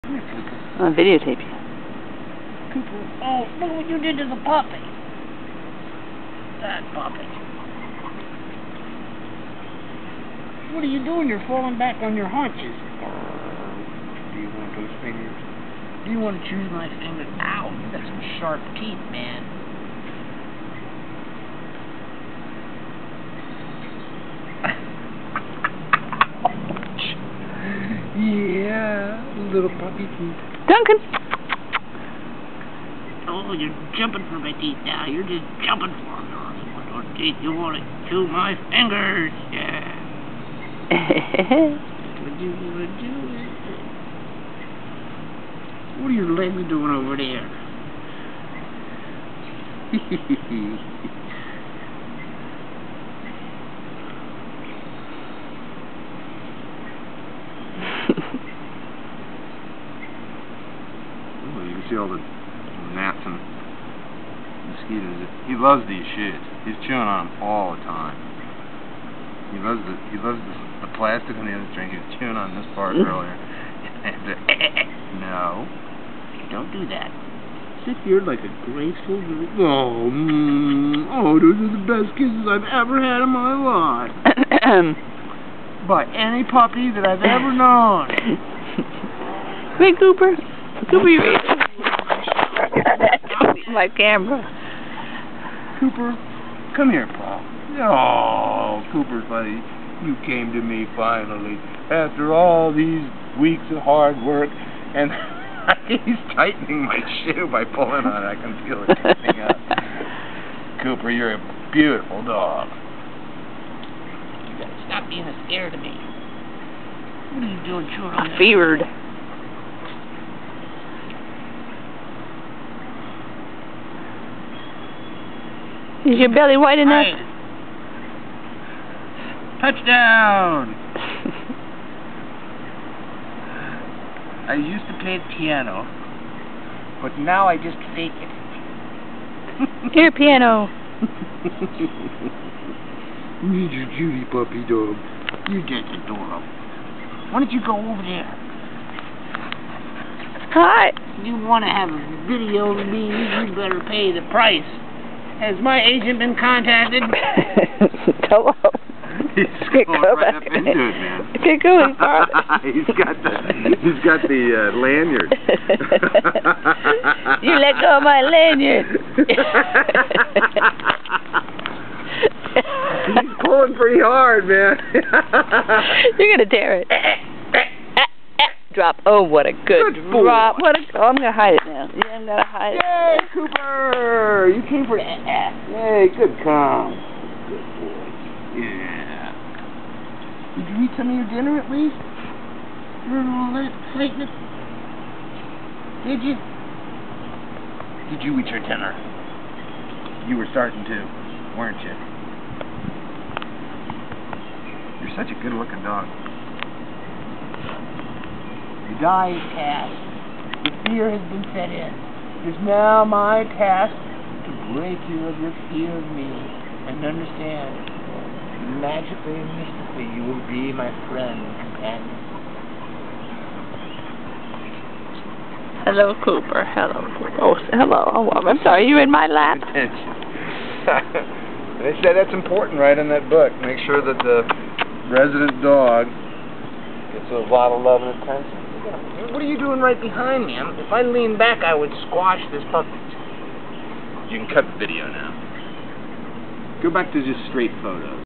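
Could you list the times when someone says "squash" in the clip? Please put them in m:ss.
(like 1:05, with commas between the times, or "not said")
4:02.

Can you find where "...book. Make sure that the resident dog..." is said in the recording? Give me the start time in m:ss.
3:53.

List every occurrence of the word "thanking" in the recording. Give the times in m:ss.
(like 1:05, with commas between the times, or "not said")
not said.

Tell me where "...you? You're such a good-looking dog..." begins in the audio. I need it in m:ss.
3:21.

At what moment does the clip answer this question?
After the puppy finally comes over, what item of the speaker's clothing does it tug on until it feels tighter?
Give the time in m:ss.
1:47.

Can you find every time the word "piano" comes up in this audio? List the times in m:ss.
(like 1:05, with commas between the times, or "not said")
2:15, 2:20.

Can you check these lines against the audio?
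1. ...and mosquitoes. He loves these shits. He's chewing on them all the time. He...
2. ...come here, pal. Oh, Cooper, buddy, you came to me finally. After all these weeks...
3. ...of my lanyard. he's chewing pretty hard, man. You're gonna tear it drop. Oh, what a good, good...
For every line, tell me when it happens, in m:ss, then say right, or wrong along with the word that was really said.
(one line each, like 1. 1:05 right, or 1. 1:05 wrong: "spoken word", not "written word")
1. 1:03 right
2. 1:36 right
3. 2:47 wrong: "pulling", not "chewing".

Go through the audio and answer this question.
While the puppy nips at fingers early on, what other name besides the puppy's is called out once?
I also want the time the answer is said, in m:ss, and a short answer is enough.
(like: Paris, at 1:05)
Duncan, at 0:30.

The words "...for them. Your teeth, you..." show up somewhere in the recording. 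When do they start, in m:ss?
0:35.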